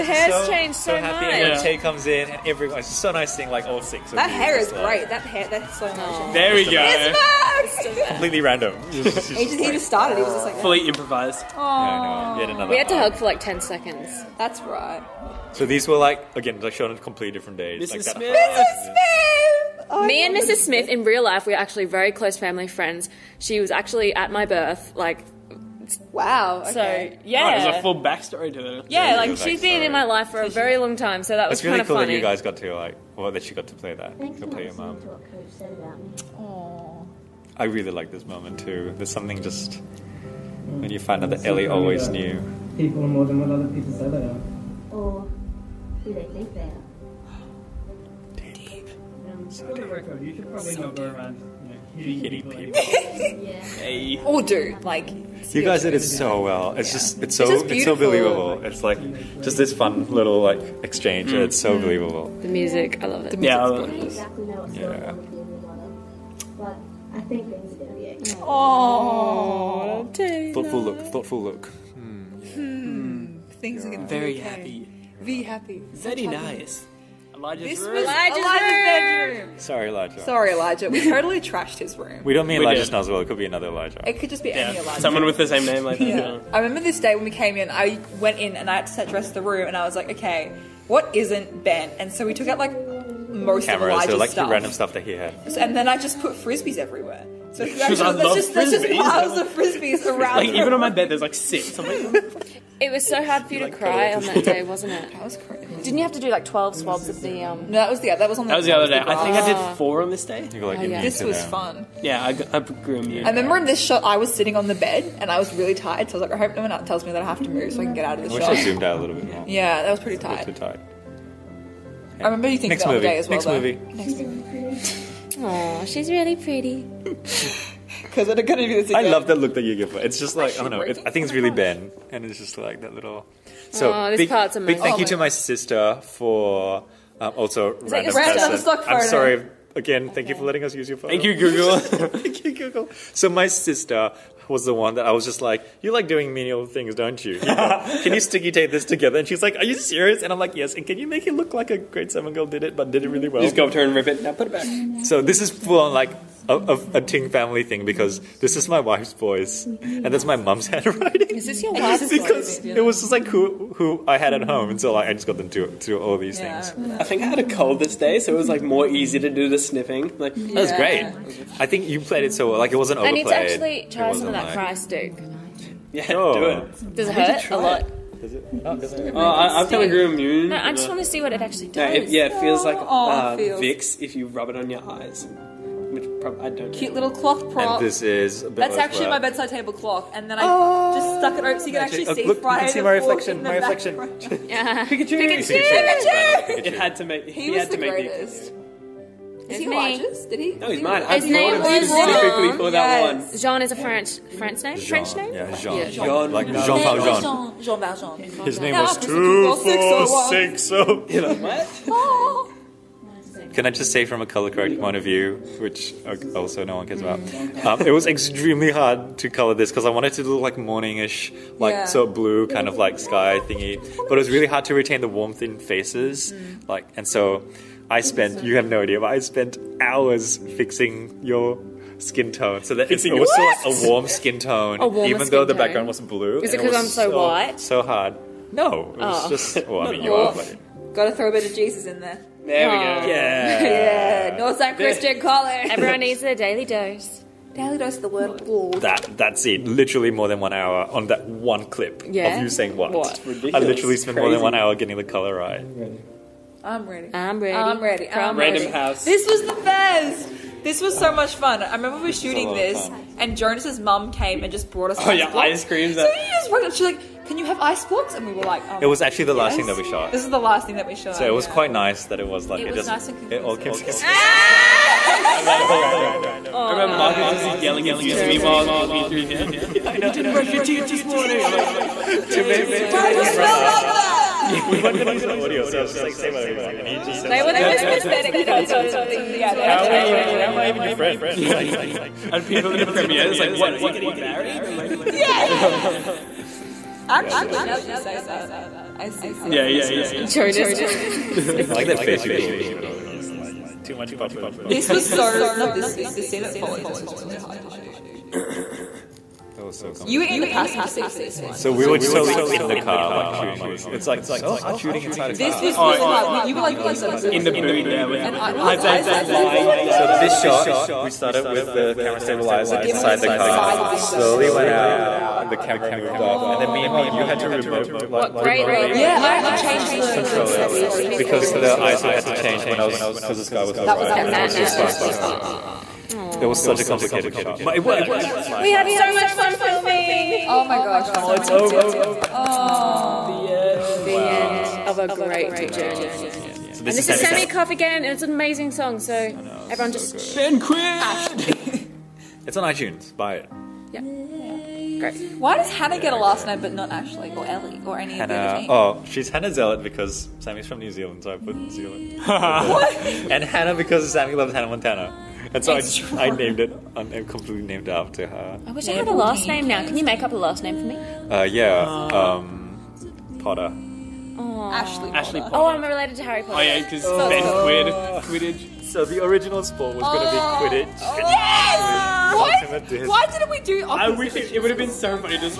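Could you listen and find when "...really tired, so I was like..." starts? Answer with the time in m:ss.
1:55.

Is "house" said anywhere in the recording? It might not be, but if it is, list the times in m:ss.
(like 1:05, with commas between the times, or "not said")
4:18.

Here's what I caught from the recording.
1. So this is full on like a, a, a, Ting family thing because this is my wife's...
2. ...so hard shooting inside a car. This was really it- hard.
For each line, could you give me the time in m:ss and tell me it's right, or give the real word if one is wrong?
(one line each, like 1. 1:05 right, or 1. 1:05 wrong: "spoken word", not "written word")
1. 2:35 right
2. 5:14 right.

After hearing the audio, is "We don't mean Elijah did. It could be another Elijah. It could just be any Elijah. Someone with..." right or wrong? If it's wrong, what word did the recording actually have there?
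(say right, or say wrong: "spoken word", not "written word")
right.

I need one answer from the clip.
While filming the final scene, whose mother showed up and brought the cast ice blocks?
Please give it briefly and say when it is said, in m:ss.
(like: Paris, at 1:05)
Jonas's mum, at 4:23.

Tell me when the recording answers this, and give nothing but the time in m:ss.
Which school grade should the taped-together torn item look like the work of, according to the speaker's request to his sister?
2:31.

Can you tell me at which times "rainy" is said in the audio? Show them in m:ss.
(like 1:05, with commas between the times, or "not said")
not said.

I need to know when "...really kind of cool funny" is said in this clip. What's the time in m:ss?
0:31.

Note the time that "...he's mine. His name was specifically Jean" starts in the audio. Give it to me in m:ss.
3:20.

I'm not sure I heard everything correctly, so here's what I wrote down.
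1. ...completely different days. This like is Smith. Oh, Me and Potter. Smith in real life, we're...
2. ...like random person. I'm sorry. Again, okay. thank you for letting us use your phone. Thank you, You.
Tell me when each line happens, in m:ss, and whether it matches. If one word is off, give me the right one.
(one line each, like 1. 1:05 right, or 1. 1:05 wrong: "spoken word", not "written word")
1. 0:16 wrong: "Mrs", not "Potter"
2. 2:18 wrong: "Google", not "You".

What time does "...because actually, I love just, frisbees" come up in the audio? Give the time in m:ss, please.
1:37.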